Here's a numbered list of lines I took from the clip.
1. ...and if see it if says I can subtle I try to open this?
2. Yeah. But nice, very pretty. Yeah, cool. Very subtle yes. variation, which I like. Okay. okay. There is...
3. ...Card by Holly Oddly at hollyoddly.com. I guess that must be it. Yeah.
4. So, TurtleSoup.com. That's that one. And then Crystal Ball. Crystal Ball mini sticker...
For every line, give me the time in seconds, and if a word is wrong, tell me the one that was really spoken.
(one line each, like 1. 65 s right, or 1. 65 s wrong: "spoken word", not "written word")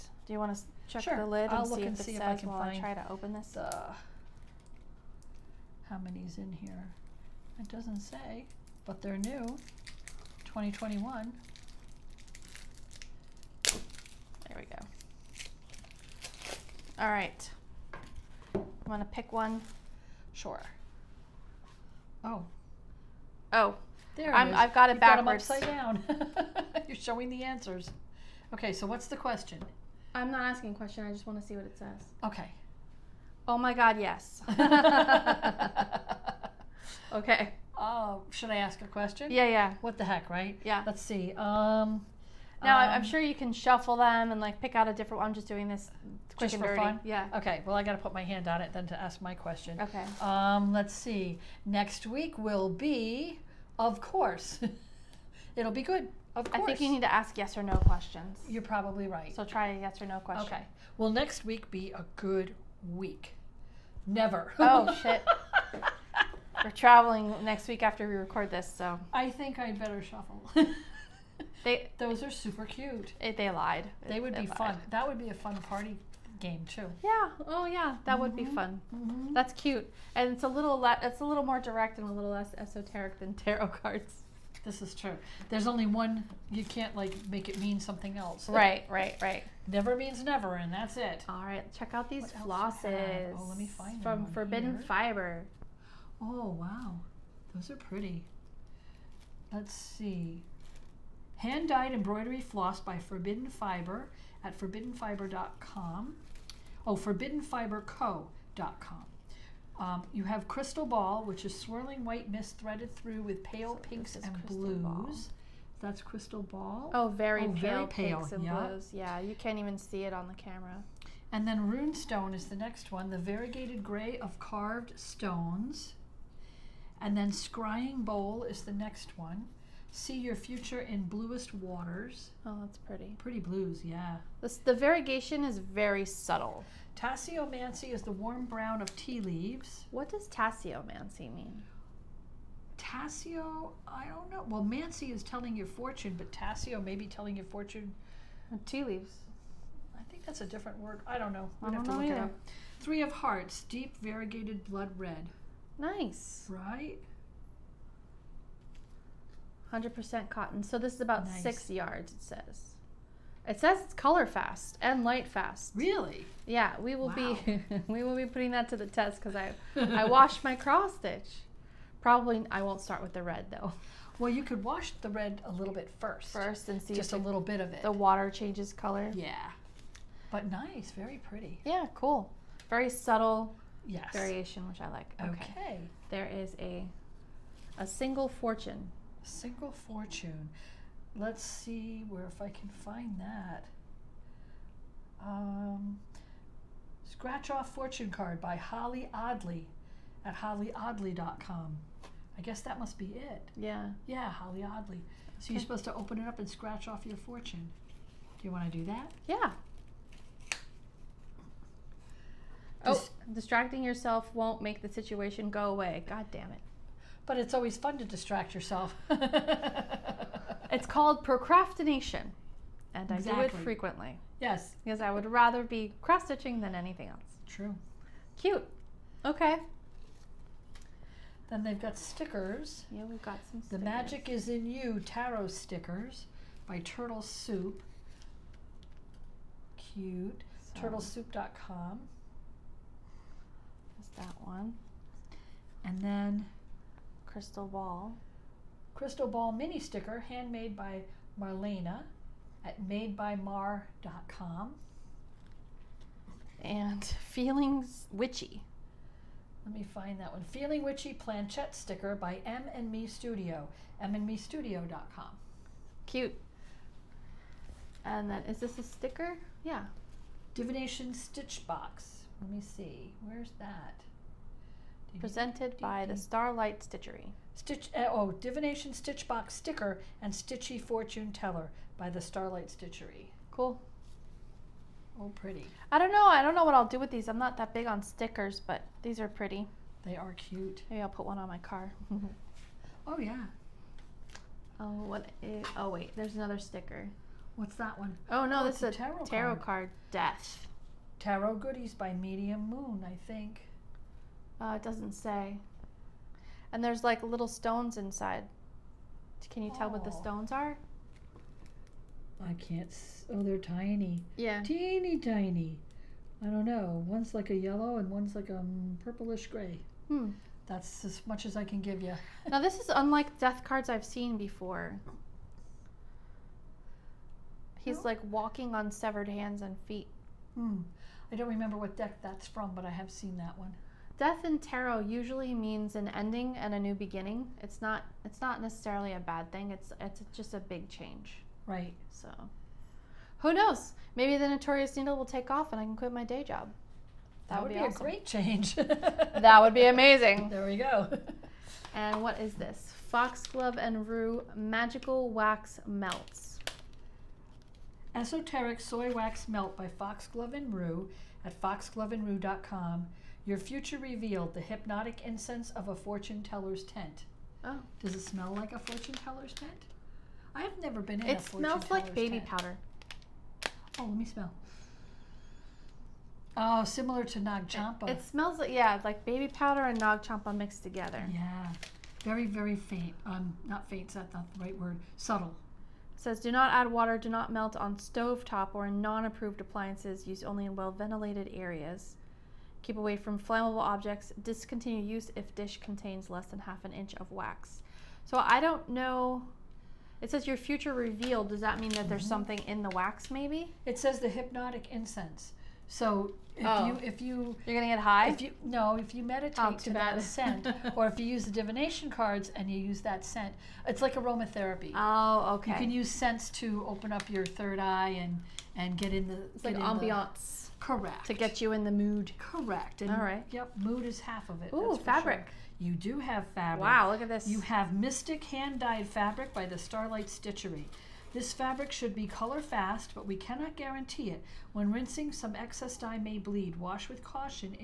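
1. 1 s wrong: "while", not "subtle"
2. 179 s right
3. 198 s right
4. 240 s right.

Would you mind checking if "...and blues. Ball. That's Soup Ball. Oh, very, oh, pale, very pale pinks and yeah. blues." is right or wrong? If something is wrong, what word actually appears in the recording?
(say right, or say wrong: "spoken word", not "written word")
wrong: "Crystal", not "Soup".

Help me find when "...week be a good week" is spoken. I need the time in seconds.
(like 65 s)
61 s.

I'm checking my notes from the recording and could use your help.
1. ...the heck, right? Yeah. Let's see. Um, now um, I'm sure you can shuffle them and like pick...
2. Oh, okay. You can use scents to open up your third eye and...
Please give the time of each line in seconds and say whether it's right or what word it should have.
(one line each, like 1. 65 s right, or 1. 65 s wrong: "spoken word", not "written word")
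1. 39 s right
2. 414 s right.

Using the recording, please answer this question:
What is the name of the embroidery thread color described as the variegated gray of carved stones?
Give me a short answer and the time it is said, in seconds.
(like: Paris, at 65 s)
Runestone, at 121 s.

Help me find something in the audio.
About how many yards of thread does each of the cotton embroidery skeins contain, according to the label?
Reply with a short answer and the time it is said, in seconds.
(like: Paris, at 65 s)
6 yards, at 161 s.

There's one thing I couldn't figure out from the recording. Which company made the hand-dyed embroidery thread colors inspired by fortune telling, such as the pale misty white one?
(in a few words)
Forbidden Fiber.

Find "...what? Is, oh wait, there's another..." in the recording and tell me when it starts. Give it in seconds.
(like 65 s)
295 s.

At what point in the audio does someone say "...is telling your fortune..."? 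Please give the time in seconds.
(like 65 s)
145 s.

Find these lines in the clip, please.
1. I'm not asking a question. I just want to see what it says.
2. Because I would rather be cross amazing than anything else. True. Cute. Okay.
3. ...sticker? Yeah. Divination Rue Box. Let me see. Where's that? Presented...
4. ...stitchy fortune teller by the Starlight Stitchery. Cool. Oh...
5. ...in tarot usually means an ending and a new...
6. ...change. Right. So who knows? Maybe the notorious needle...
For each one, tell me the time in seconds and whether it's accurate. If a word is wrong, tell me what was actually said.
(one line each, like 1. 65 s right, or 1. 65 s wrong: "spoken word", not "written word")
1. 30 s right
2. 224 s wrong: "stitching", not "amazing"
3. 268 s wrong: "Stitch", not "Rue"
4. 280 s right
5. 334 s right
6. 340 s right.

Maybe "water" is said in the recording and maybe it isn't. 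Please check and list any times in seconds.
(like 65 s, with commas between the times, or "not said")
131 s, 177 s, 386 s.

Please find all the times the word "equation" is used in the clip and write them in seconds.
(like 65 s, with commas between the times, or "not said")
not said.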